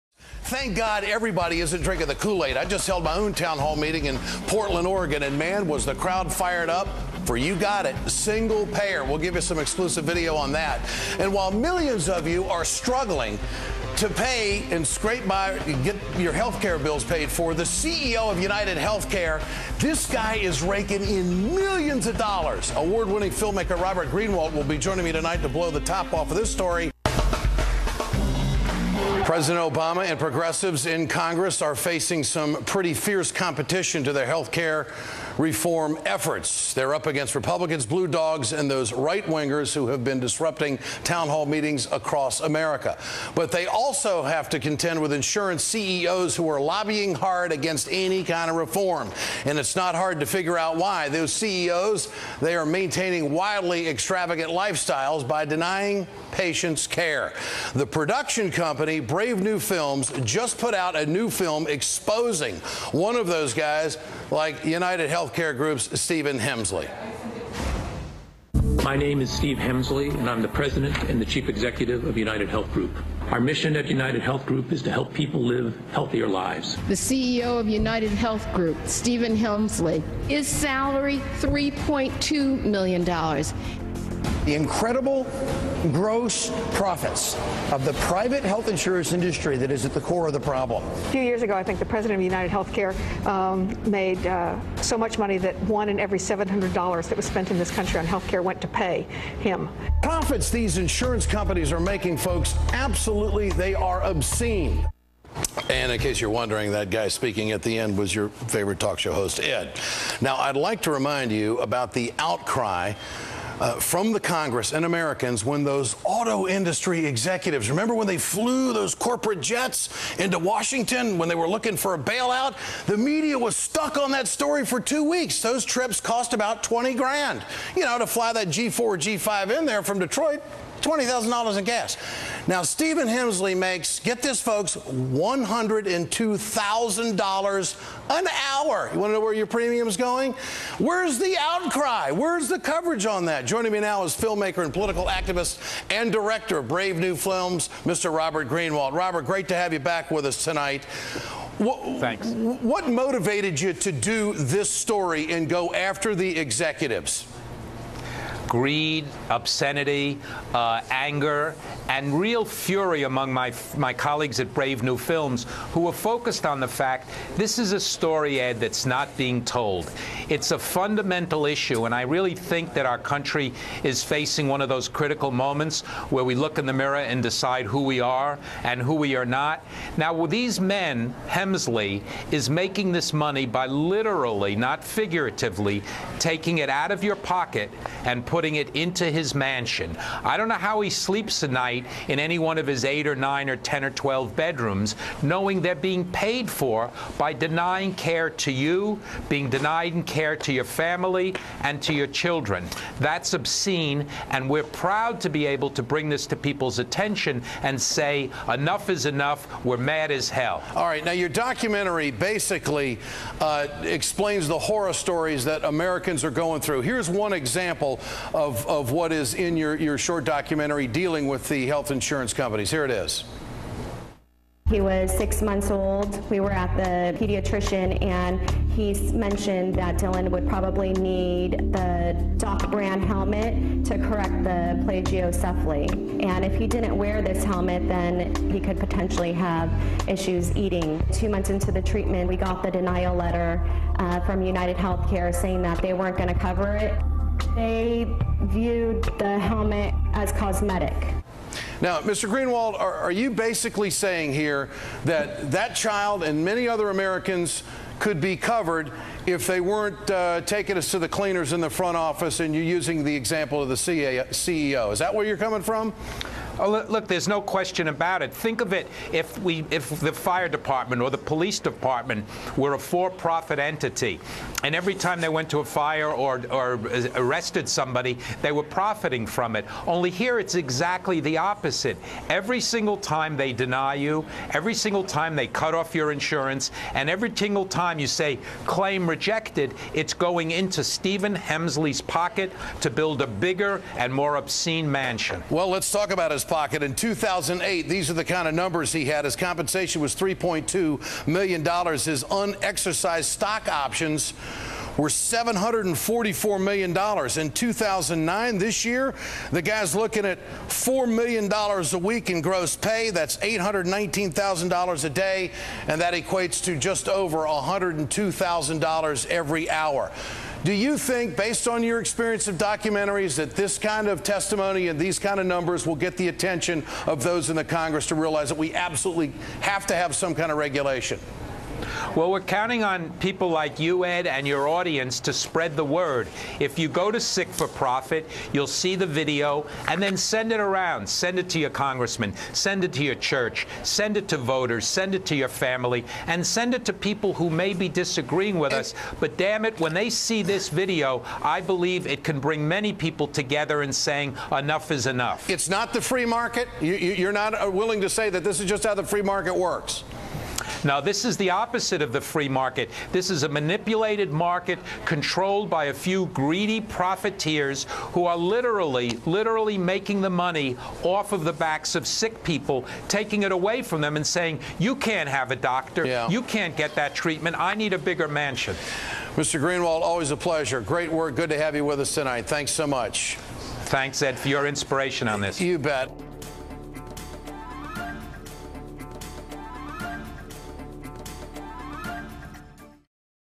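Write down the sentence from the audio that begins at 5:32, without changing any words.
Well, we're counting on people like you, Ed, and your audience to spread the word.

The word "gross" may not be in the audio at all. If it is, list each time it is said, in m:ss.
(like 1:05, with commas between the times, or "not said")
1:25, 5:12.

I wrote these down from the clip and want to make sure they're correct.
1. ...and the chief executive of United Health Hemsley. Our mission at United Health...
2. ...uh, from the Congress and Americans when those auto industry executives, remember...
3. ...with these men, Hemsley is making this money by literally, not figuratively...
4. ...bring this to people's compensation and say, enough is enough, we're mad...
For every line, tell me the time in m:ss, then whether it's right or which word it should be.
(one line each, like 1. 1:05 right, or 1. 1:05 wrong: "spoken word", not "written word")
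1. 1:11 wrong: "Group", not "Hemsley"
2. 1:53 right
3. 3:00 right
4. 3:25 wrong: "attention", not "compensation".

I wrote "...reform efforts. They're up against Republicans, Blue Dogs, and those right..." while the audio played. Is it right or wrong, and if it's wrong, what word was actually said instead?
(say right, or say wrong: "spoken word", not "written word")
right.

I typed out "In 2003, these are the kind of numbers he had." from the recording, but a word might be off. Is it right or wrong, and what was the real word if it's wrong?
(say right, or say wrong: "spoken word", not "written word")
wrong: "2008", not "2003".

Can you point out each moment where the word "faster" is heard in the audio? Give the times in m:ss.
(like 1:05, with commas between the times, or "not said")
not said.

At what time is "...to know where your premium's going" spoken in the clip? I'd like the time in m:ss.
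2:19.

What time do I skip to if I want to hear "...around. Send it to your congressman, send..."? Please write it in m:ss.
5:40.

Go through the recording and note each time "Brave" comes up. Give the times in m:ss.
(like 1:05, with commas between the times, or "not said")
0:58, 2:26, 2:44.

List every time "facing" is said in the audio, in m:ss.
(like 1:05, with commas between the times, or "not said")
0:31, 2:54.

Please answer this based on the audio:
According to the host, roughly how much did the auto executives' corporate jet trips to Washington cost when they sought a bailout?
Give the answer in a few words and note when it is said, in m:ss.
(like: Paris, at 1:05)
20 grand, at 2:06.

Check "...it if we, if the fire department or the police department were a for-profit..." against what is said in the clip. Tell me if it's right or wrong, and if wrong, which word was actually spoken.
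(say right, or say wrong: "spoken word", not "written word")
right.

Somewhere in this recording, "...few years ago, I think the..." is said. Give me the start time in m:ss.
1:31.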